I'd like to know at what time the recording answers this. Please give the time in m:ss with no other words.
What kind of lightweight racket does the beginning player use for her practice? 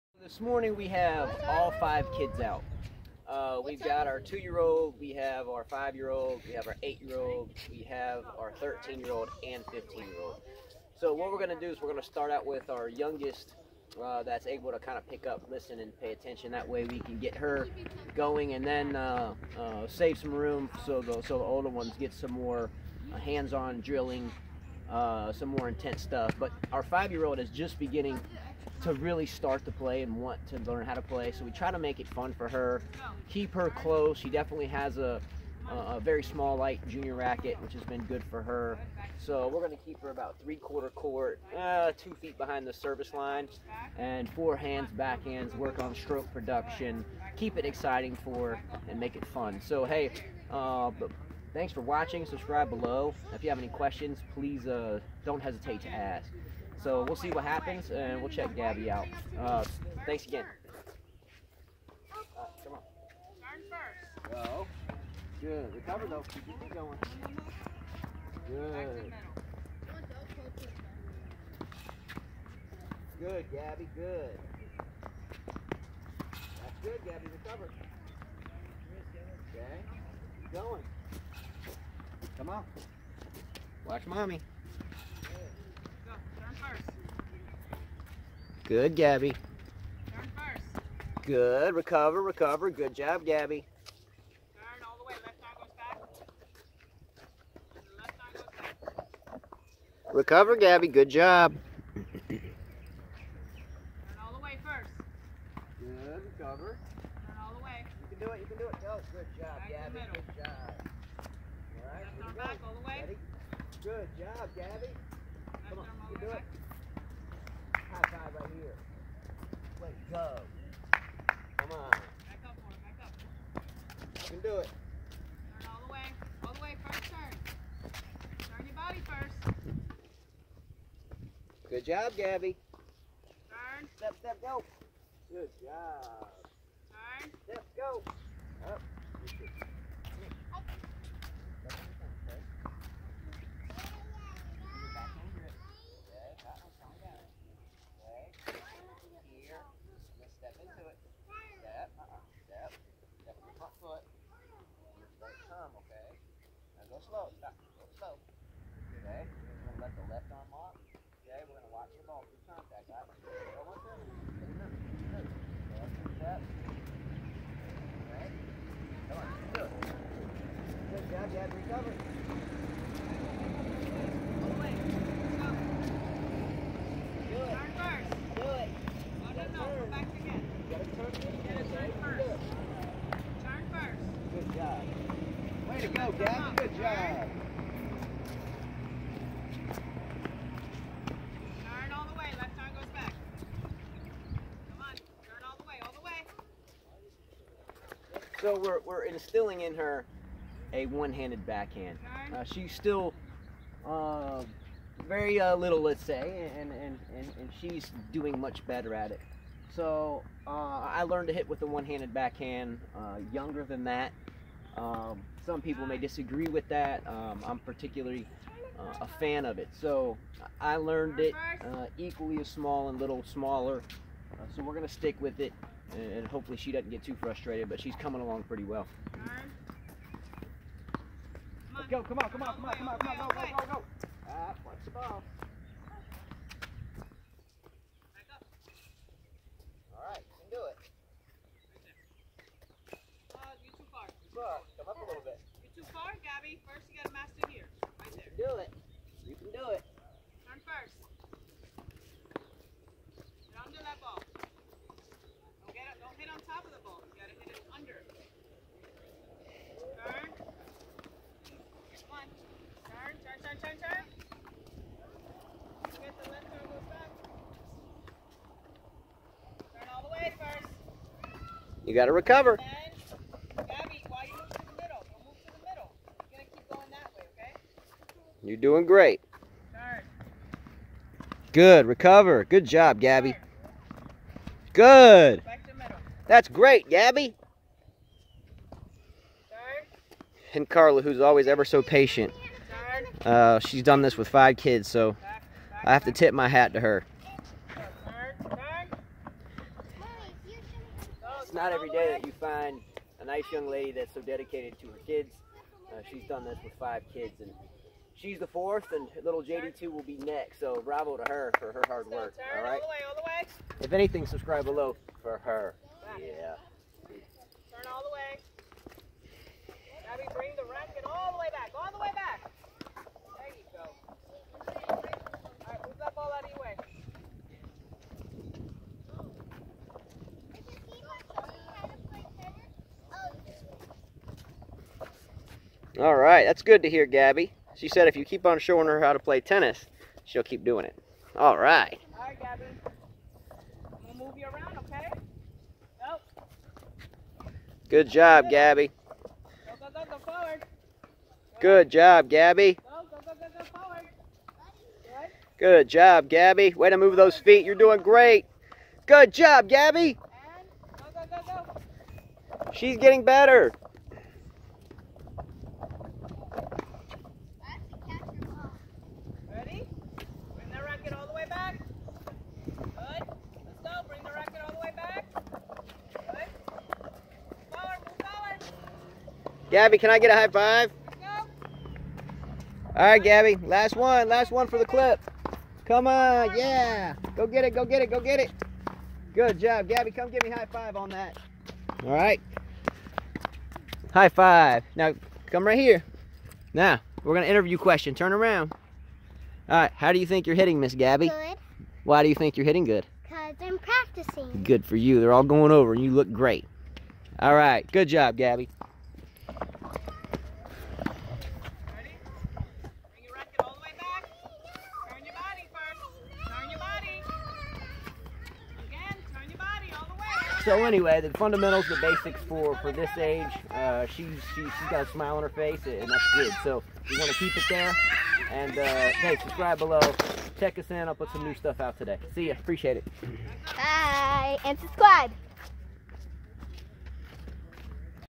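0:36.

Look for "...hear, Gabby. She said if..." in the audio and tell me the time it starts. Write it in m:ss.
5:36.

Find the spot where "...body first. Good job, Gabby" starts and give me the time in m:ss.
2:08.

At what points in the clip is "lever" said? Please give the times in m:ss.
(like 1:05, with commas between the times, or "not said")
not said.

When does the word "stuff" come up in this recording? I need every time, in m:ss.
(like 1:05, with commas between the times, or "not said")
0:26, 7:11.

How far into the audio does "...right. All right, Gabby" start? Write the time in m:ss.
5:41.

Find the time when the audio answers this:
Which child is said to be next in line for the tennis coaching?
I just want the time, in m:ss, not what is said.
5:09.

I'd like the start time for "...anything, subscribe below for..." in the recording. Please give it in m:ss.
5:13.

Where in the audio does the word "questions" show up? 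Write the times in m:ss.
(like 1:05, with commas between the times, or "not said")
0:53, 6:37.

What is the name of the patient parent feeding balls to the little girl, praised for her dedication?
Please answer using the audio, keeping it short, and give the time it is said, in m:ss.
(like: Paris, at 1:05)
Carla, at 4:50.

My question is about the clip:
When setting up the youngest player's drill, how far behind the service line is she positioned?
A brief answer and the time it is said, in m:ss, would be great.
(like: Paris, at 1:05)
2 feet, at 0:41.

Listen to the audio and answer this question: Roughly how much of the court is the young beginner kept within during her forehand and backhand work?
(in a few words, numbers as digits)
three-quarter court.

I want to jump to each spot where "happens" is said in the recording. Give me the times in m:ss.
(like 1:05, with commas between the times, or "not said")
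0:57.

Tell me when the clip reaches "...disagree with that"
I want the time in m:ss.
3:35.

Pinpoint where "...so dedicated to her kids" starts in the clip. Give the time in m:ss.
5:04.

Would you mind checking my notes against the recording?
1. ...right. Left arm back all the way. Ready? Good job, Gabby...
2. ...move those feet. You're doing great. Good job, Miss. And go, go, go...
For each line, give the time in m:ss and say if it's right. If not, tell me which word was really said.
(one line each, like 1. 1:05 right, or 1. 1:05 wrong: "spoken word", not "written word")
1. 1:51 right
2. 5:56 wrong: "Gabby", not "Miss".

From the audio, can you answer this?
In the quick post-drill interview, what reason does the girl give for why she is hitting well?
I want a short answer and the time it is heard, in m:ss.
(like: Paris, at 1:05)
Because I'm practicing, at 6:43.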